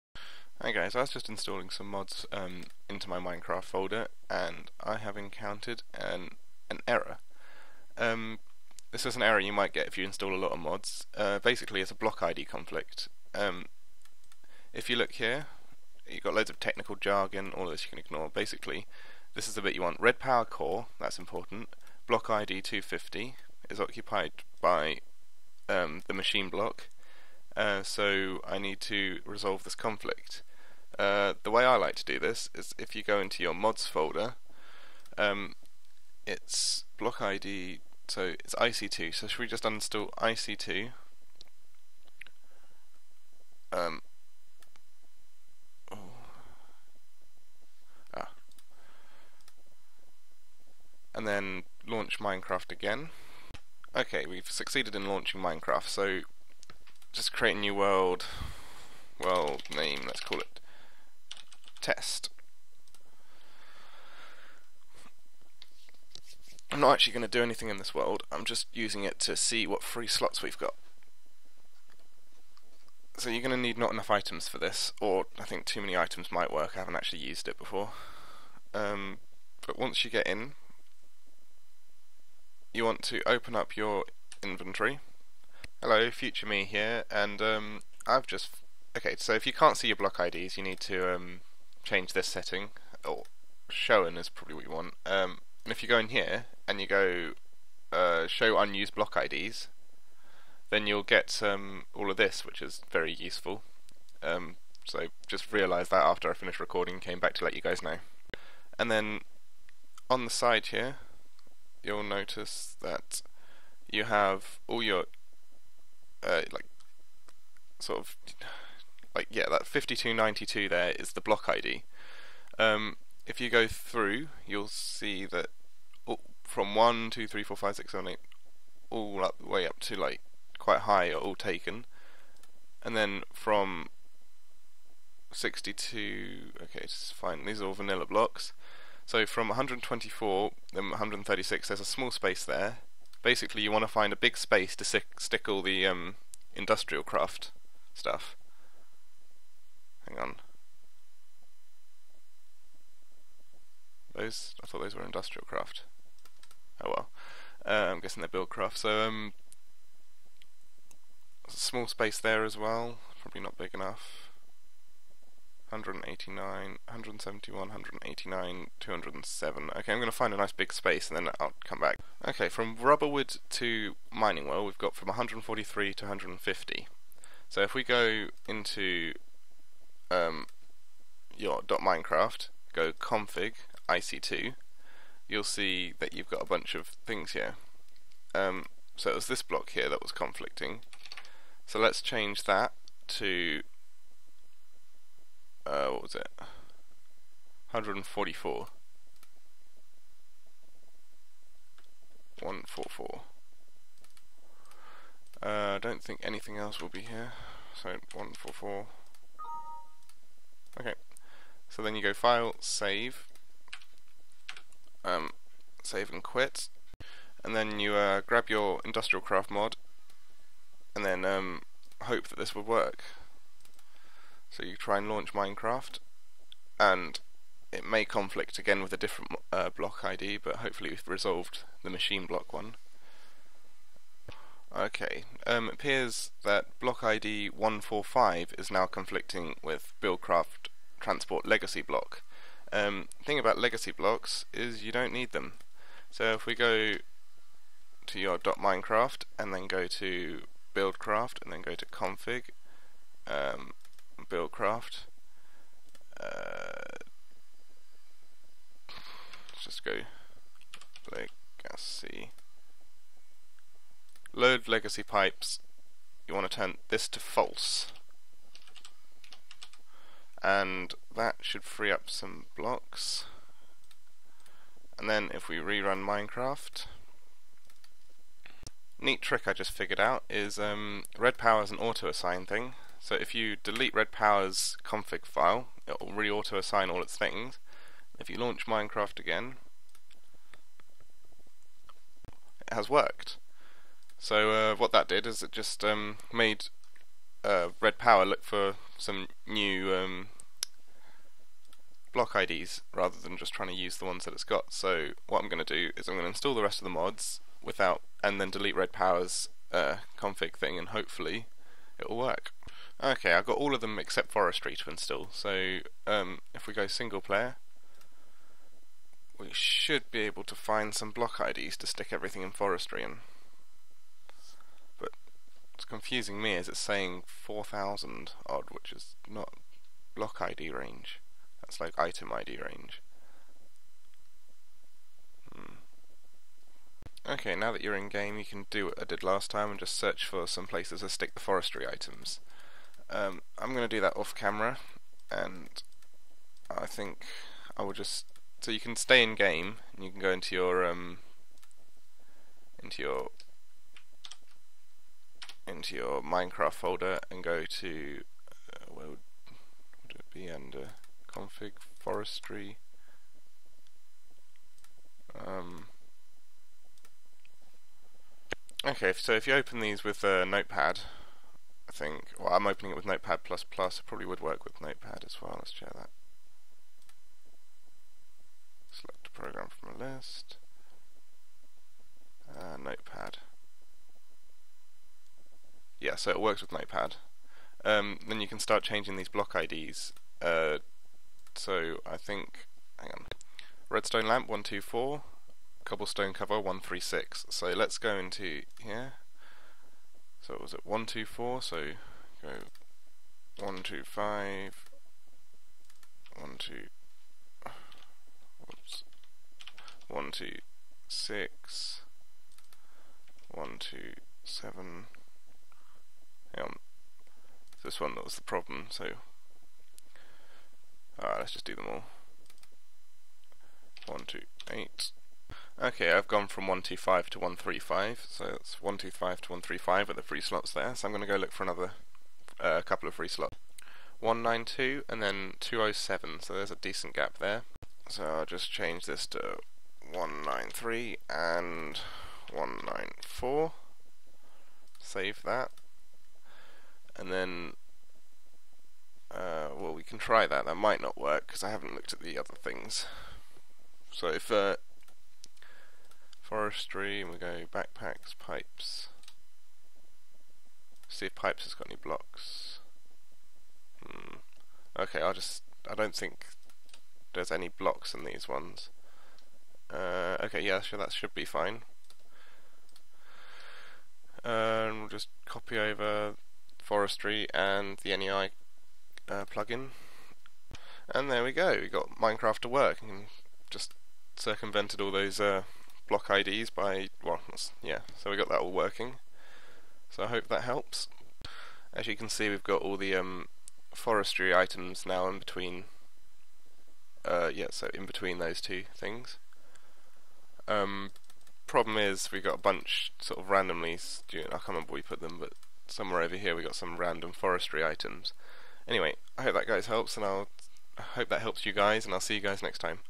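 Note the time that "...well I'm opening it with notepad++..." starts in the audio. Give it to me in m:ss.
6:12.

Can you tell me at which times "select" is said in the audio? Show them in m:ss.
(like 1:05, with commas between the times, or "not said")
6:18.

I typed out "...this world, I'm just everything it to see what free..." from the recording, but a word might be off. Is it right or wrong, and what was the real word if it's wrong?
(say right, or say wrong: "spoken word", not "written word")
wrong: "using", not "everything".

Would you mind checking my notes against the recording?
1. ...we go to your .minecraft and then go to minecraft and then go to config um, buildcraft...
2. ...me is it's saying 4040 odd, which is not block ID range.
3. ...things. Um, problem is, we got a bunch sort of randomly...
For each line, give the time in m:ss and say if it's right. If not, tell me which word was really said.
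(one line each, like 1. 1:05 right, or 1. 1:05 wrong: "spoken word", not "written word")
1. 4:06 wrong: "buildcraft", not "minecraft"
2. 5:26 wrong: "4000", not "4040"
3. 8:18 right.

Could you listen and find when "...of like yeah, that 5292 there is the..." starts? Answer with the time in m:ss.
1:57.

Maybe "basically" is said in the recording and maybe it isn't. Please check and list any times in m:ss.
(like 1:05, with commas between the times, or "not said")
0:11, 0:18, 2:23.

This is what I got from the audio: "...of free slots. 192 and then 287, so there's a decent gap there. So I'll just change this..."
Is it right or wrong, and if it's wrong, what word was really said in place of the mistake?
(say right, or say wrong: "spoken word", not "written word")
wrong: "207", not "287".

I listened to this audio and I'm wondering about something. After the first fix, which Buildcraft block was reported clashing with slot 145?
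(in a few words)
transport legacy block.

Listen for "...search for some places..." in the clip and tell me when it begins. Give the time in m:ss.
5:39.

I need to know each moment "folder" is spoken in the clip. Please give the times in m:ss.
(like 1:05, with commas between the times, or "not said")
0:03, 0:33, 5:56.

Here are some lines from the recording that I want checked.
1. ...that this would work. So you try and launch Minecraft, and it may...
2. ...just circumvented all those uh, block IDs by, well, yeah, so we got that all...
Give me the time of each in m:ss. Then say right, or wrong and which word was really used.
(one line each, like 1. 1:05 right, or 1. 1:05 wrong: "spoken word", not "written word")
1. 3:42 right
2. 8:03 right.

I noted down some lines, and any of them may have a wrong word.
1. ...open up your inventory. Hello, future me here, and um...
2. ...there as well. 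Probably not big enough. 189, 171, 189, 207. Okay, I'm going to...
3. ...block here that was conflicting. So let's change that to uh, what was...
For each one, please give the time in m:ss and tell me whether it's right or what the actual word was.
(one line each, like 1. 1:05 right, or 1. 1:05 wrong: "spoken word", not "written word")
1. 1:23 right
2. 2:42 right
3. 3:09 right.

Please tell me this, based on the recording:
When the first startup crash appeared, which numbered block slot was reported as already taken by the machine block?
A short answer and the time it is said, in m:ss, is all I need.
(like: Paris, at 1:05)
250, at 0:22.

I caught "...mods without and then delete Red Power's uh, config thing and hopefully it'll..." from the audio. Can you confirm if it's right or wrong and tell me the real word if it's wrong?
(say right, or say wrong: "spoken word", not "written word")
right.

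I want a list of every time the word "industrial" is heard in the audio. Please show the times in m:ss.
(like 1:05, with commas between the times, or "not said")
2:26, 2:35, 3:38.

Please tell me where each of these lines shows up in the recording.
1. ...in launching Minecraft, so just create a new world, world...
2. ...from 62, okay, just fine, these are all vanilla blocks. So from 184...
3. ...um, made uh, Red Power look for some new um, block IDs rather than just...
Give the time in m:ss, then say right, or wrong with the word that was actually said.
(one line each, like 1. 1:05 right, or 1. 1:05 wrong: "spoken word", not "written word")
1. 0:54 right
2. 2:13 wrong: "124", not "184"
3. 4:55 right.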